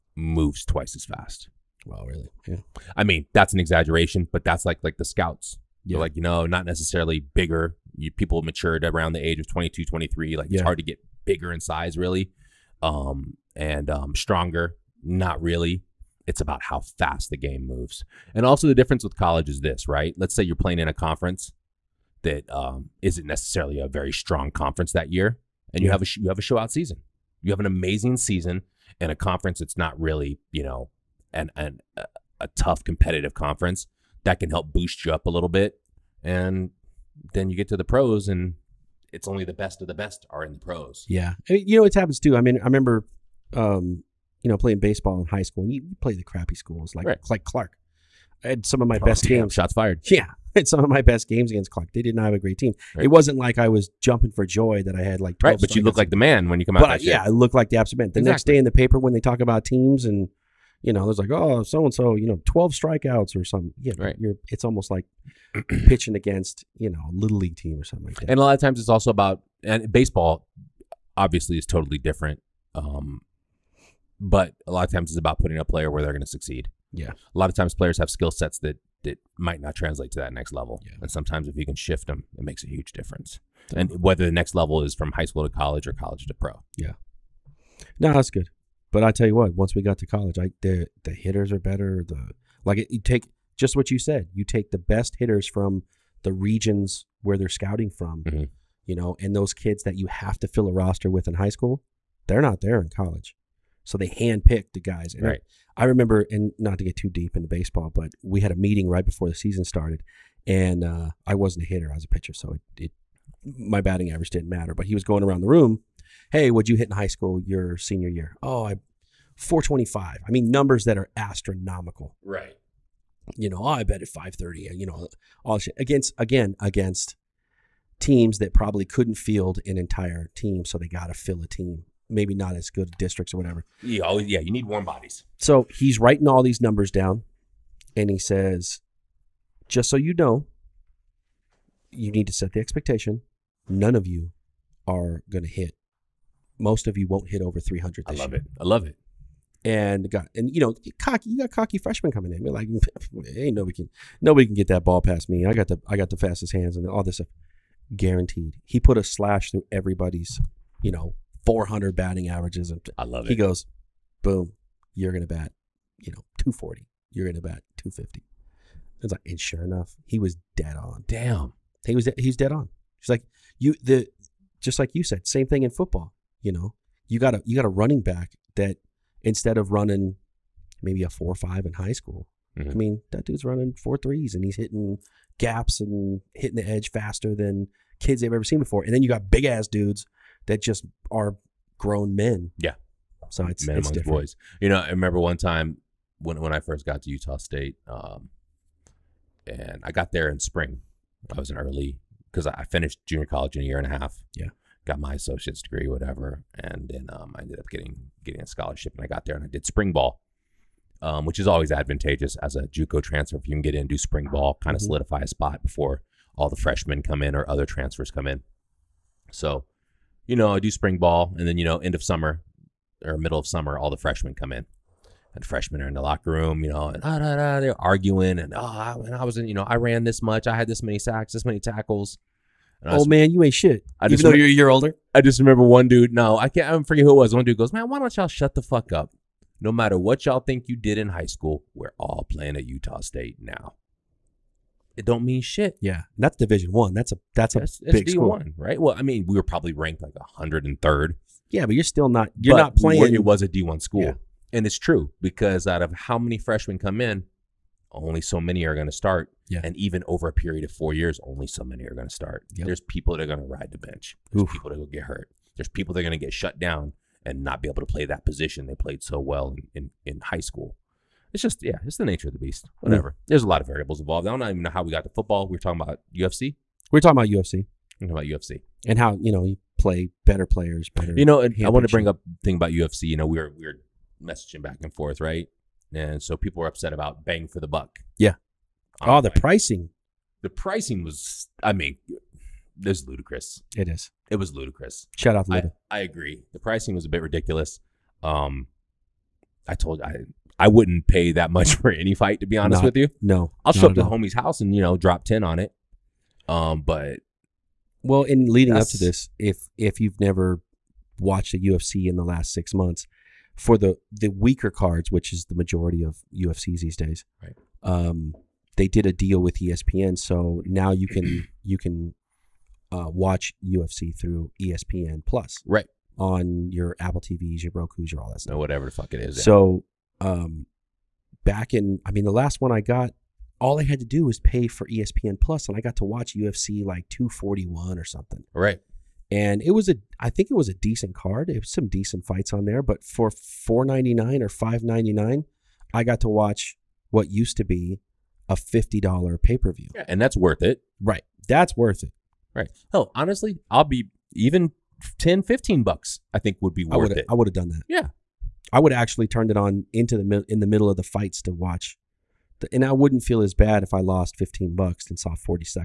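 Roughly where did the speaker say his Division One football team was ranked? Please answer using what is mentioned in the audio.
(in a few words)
103rd.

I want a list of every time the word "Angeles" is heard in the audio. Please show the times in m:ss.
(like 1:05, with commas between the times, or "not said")
not said.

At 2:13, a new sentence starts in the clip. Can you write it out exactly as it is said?
Yeah, oh, yeah, you need warm bodies.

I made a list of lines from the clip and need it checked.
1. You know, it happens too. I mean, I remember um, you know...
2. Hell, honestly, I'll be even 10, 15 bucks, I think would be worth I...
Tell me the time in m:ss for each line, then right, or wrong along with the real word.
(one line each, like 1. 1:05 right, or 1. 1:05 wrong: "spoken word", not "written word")
1. 0:41 right
2. 5:52 right.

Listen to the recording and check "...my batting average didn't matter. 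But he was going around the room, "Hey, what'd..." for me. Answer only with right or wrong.
right.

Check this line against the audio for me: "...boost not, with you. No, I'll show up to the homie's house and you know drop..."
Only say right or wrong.
wrong.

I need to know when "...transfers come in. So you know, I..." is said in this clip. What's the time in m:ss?
3:37.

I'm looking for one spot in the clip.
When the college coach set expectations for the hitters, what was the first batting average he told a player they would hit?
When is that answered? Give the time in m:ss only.
2:46.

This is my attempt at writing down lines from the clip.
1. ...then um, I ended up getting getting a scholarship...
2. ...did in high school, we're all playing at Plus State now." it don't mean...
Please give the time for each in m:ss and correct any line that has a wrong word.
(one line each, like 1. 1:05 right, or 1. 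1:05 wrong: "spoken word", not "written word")
1. 3:26 right
2. 4:00 wrong: "Utah", not "Plus".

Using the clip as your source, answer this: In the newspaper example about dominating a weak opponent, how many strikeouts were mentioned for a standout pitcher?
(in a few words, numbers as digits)
12.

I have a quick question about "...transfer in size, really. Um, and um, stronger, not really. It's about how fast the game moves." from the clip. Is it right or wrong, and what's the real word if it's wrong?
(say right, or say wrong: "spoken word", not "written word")
wrong: "bigger", not "transfer".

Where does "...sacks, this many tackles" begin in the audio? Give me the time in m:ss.
3:50.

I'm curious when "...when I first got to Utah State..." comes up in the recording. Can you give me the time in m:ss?
3:16.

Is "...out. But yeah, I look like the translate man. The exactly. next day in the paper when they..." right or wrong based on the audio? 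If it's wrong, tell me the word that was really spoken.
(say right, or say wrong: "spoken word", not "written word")
wrong: "absolute", not "translate".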